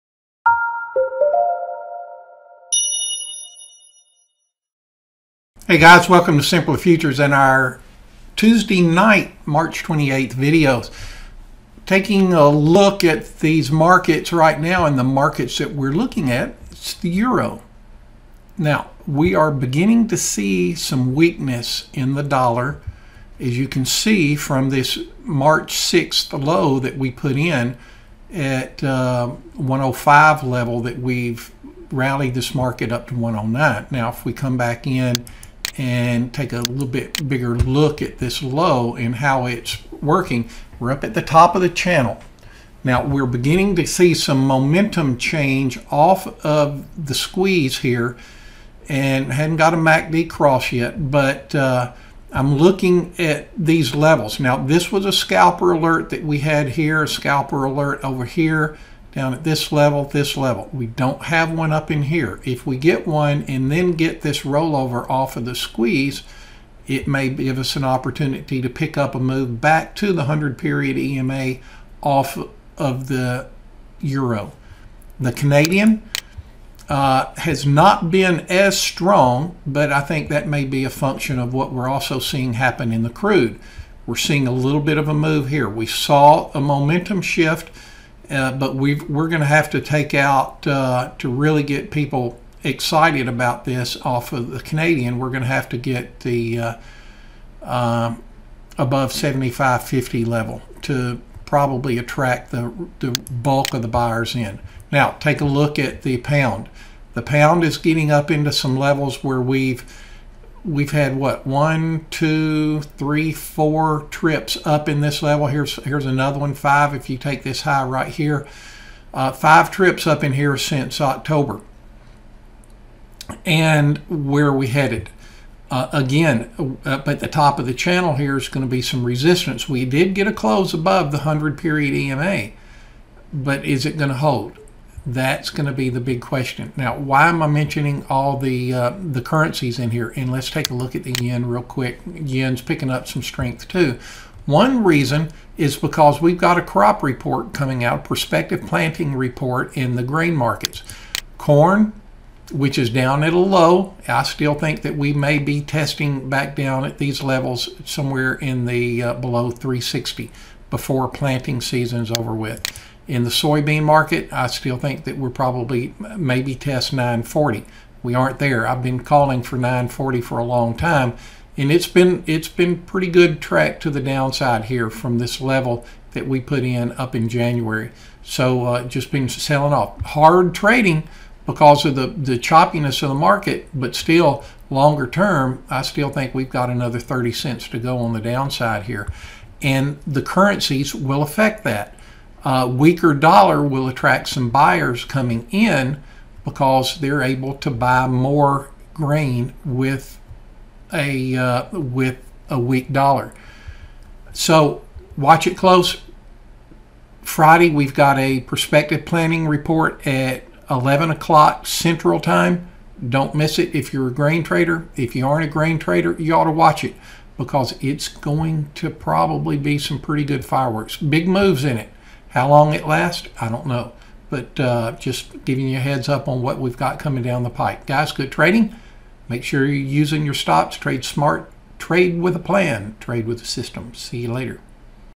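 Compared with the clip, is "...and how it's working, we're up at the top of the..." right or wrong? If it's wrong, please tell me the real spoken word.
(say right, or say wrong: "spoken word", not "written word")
right.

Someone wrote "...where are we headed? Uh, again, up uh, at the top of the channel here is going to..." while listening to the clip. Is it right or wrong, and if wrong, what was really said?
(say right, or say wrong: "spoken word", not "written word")
right.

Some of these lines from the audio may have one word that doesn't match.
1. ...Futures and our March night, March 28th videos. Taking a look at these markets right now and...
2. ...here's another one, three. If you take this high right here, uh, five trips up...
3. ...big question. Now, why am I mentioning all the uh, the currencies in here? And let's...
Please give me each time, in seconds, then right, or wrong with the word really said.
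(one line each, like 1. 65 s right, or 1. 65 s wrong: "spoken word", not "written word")
1. 6 s wrong: "Tuesday", not "March"
2. 115 s wrong: "five", not "three"
3. 136 s right.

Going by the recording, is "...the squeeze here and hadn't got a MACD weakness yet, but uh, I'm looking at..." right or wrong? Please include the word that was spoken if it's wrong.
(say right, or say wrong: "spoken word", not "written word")
wrong: "cross", not "weakness".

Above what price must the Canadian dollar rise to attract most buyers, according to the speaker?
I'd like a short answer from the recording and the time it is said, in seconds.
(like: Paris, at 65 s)
75.50, at 99 s.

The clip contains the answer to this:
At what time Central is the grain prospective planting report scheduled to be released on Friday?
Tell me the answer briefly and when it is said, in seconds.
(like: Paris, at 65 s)
11 o'clock, at 210 s.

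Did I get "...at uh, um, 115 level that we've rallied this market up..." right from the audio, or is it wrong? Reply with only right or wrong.
wrong.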